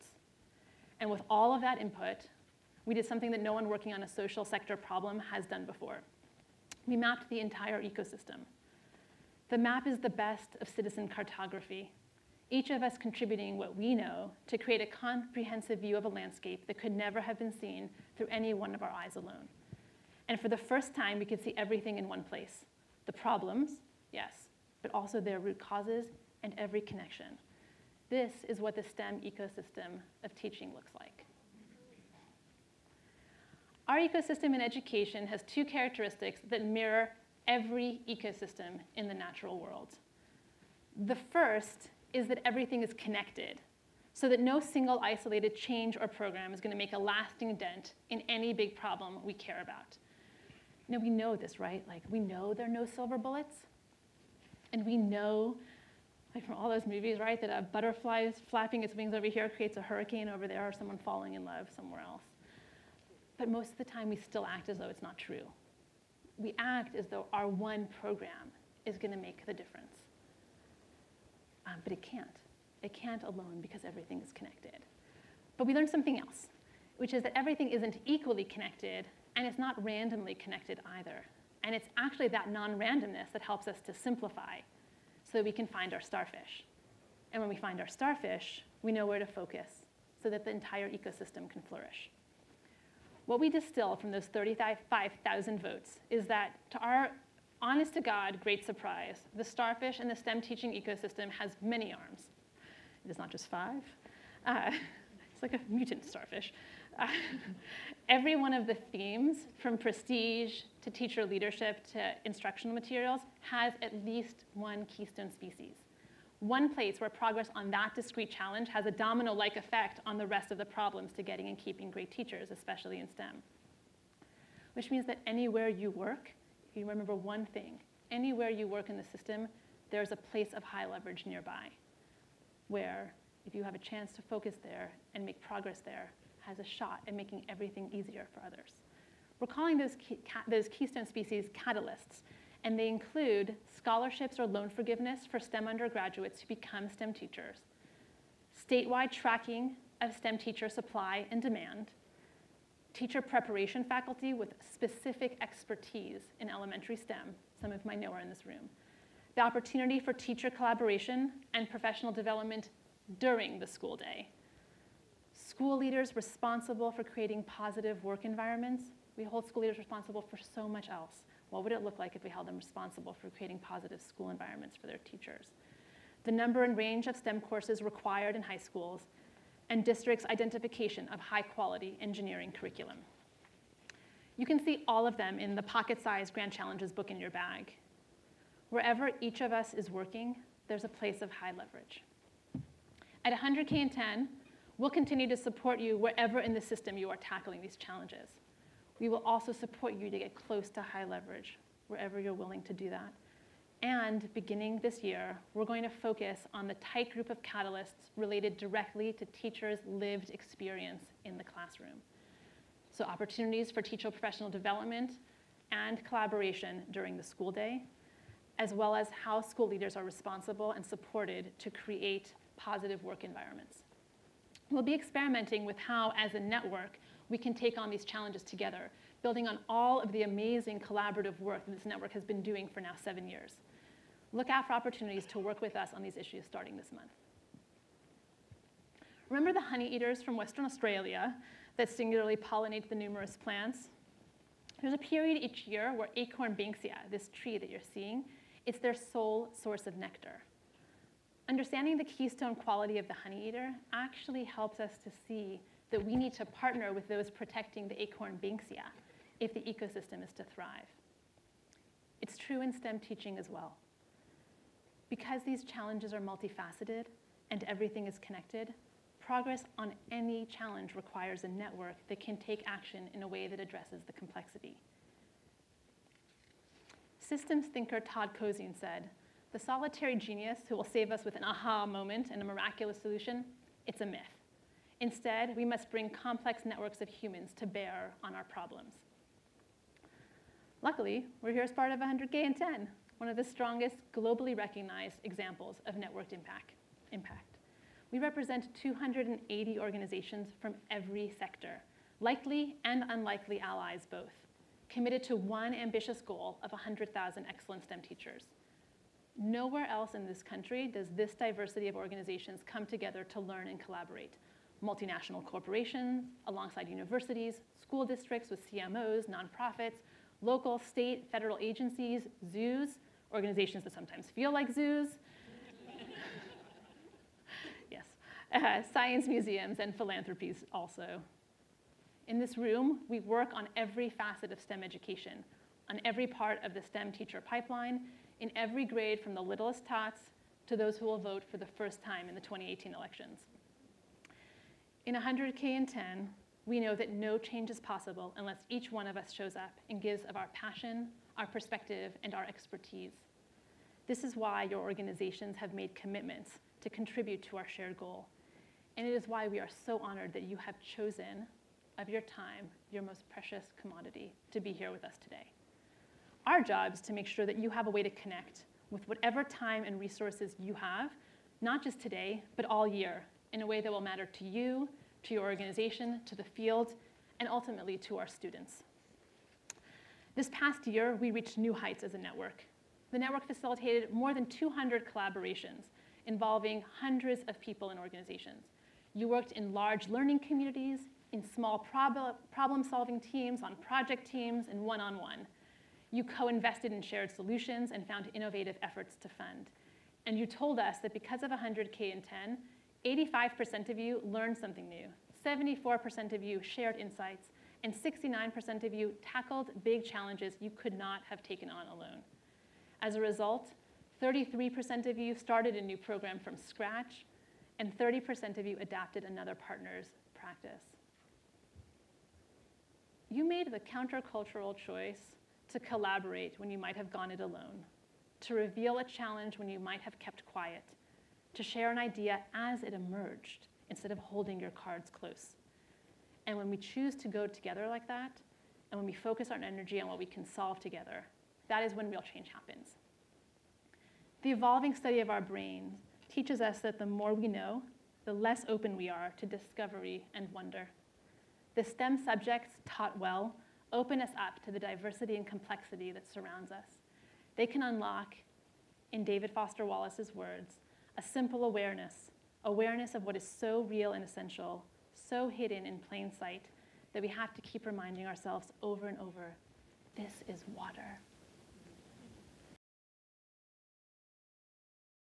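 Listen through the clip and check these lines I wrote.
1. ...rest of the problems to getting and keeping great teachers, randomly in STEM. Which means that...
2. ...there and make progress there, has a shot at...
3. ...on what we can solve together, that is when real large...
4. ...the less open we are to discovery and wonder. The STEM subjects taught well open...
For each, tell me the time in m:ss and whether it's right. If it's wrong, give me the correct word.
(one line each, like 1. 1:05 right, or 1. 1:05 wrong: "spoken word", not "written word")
1. 2:00 wrong: "especially", not "randomly"
2. 2:14 right
3. 7:20 wrong: "change", not "large"
4. 7:28 right.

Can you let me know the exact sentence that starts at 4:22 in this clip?
It's true in STEM teaching as well.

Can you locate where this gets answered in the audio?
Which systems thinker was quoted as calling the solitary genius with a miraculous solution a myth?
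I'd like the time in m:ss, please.
4:38.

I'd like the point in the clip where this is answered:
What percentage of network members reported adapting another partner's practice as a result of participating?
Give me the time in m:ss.
6:57.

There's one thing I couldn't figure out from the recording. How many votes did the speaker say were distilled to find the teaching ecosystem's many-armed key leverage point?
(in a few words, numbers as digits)
35,000.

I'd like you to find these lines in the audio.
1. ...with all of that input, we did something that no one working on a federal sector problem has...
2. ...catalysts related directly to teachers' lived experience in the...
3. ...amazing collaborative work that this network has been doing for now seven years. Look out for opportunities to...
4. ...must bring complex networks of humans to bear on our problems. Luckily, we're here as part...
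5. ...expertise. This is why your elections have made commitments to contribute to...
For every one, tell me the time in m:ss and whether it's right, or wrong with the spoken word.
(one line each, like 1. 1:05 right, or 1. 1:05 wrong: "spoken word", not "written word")
1. 0:01 wrong: "social", not "federal"
2. 3:27 right
3. 3:50 right
4. 4:45 right
5. 5:52 wrong: "organizations", not "elections".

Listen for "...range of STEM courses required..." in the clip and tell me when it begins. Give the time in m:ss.
2:56.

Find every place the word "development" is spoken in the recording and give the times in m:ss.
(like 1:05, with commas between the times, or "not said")
2:42, 3:34.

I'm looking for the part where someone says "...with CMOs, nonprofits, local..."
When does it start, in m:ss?
5:18.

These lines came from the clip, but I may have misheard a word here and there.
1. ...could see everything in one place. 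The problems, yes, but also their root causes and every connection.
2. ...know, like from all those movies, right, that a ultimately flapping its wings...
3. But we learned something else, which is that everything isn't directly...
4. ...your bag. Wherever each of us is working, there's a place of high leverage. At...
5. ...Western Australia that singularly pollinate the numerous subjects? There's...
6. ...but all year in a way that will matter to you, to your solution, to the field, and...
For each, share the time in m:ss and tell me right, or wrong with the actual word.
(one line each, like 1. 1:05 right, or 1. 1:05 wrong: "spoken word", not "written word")
1. 0:21 right
2. 0:54 wrong: "butterfly", not "ultimately"
3. 1:15 wrong: "equally", not "directly"
4. 3:07 right
5. 4:00 wrong: "plants", not "subjects"
6. 6:12 wrong: "organization", not "solution".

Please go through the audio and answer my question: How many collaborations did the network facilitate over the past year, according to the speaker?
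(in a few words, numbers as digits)
more than 200.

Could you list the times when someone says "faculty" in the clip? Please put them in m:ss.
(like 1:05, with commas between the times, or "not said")
2:33.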